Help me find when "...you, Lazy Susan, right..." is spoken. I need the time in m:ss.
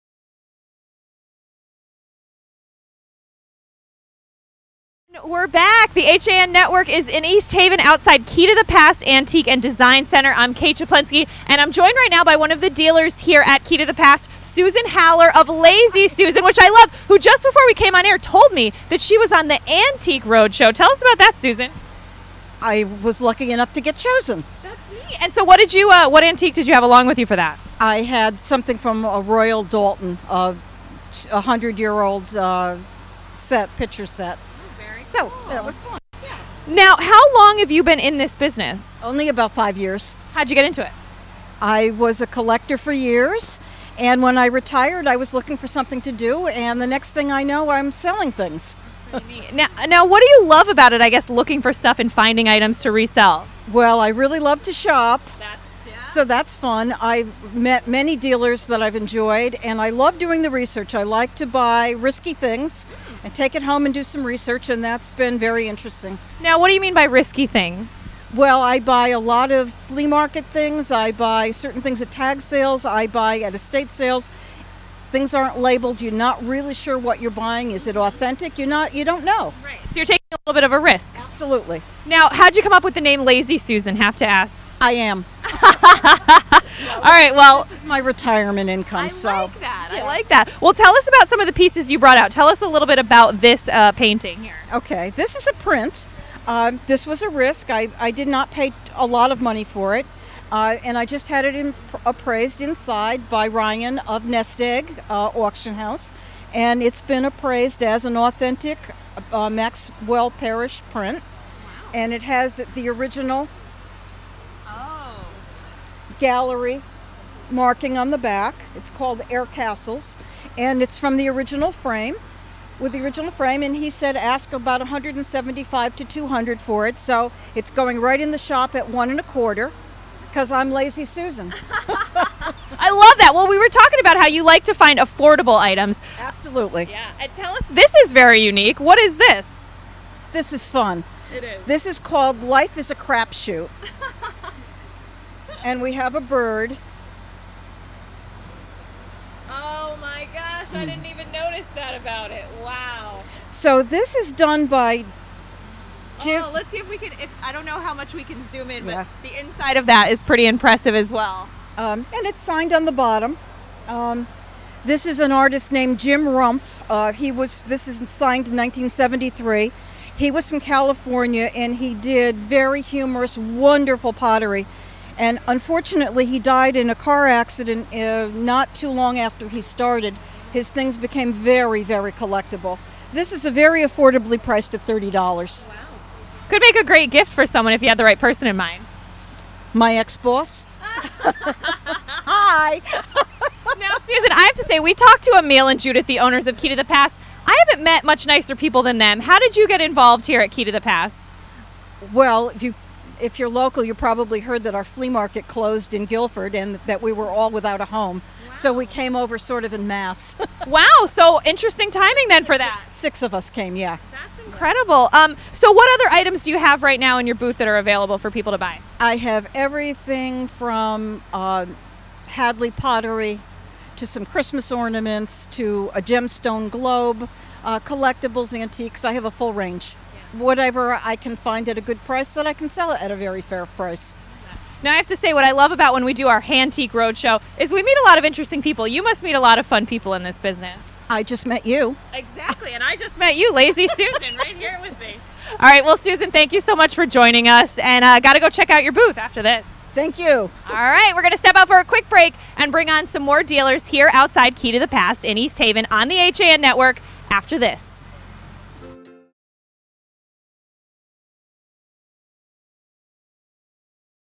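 4:03.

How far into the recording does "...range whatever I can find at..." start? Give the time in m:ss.
3:49.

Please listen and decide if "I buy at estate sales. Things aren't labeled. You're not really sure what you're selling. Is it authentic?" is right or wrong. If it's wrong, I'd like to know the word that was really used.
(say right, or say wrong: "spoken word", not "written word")
wrong: "buying", not "selling".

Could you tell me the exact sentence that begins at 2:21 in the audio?
This is called Life is a Crapshoot.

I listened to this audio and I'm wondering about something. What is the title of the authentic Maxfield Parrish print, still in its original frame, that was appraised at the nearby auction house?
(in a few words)
Air Castles.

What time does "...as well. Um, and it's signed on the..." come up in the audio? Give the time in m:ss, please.
2:40.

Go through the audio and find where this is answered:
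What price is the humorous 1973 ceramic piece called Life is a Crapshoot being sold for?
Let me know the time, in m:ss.
3:04.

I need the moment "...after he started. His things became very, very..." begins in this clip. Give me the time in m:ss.
2:59.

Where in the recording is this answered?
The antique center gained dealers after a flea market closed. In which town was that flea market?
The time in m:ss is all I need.
3:26.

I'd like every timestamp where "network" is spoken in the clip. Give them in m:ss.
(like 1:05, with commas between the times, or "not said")
0:06, 4:16.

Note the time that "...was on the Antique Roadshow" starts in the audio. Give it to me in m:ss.
0:19.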